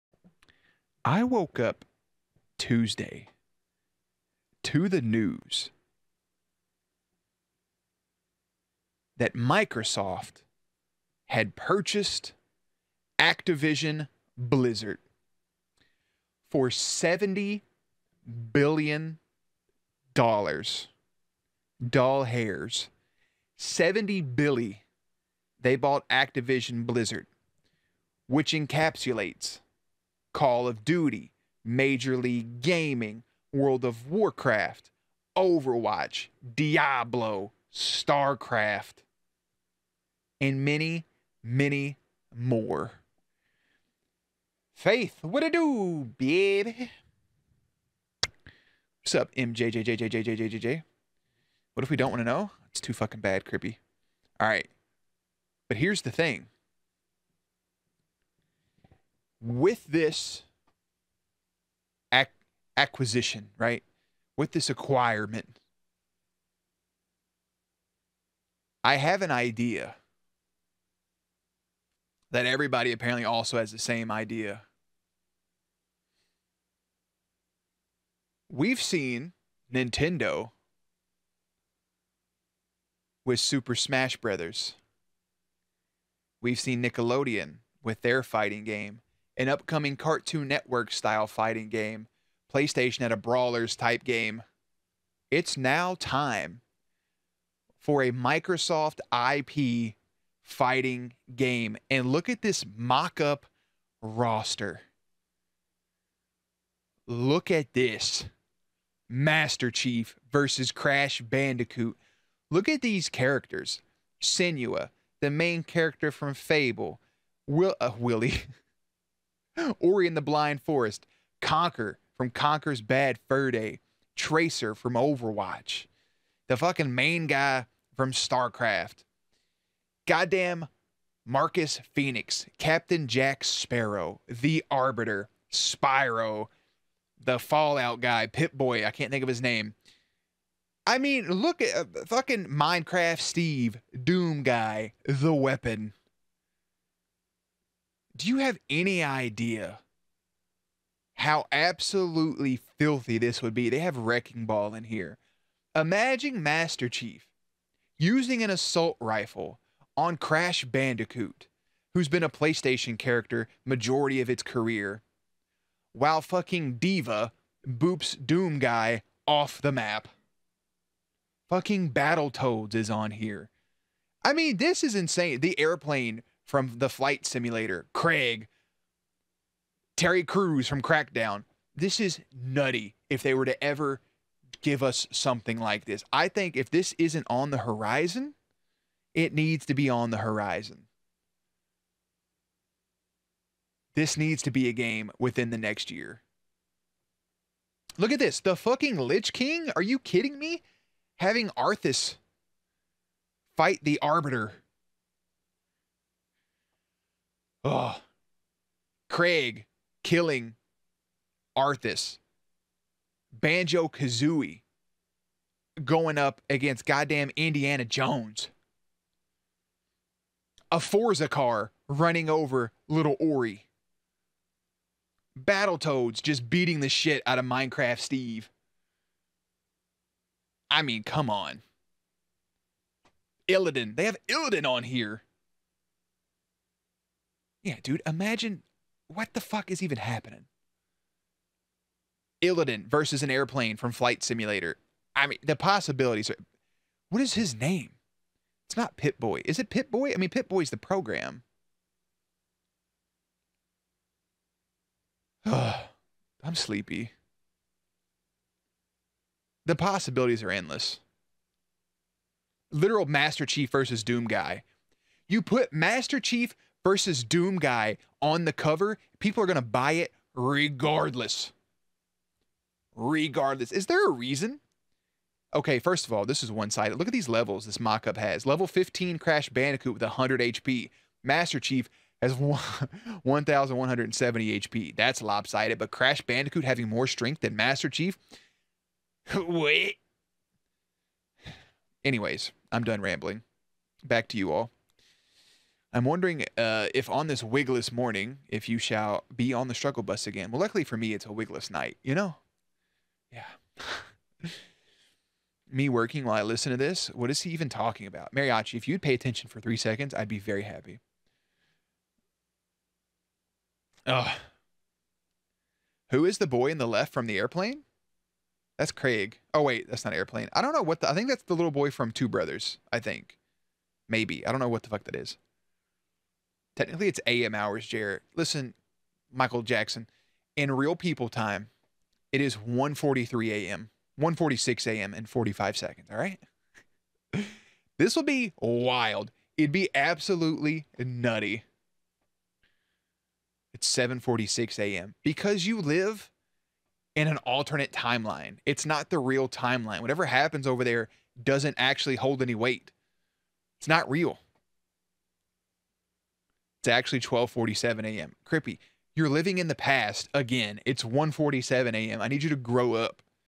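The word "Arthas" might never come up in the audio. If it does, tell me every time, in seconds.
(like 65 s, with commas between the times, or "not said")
201 s, 211 s.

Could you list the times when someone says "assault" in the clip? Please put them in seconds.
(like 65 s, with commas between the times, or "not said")
158 s.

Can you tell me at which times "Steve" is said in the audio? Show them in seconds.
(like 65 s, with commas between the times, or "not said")
143 s, 227 s.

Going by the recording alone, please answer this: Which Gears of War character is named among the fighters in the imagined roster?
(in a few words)
Marcus Phoenix.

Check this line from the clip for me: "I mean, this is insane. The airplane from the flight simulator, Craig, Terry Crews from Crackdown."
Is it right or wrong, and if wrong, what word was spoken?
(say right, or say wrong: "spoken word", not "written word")
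right.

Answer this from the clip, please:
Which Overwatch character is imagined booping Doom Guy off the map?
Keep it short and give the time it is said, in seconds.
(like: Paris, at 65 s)
D.Va, at 166 s.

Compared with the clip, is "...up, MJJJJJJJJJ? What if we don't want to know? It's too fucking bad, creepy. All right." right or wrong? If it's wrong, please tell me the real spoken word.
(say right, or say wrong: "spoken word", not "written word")
right.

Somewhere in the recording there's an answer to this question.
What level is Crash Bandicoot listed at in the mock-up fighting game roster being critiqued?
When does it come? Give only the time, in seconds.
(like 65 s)
278 s.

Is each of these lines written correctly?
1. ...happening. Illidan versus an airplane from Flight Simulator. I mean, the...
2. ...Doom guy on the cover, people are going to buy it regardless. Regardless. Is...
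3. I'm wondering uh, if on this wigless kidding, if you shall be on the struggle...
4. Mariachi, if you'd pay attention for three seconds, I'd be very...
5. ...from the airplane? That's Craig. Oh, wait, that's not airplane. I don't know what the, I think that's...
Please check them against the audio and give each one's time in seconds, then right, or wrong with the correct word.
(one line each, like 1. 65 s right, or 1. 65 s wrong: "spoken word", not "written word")
1. 239 s right
2. 267 s right
3. 295 s wrong: "morning", not "kidding"
4. 308 s right
5. 317 s right.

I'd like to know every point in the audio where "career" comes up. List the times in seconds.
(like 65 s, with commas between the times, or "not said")
164 s.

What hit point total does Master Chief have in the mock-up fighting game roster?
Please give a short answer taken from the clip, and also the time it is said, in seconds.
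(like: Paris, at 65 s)
1,170, at 282 s.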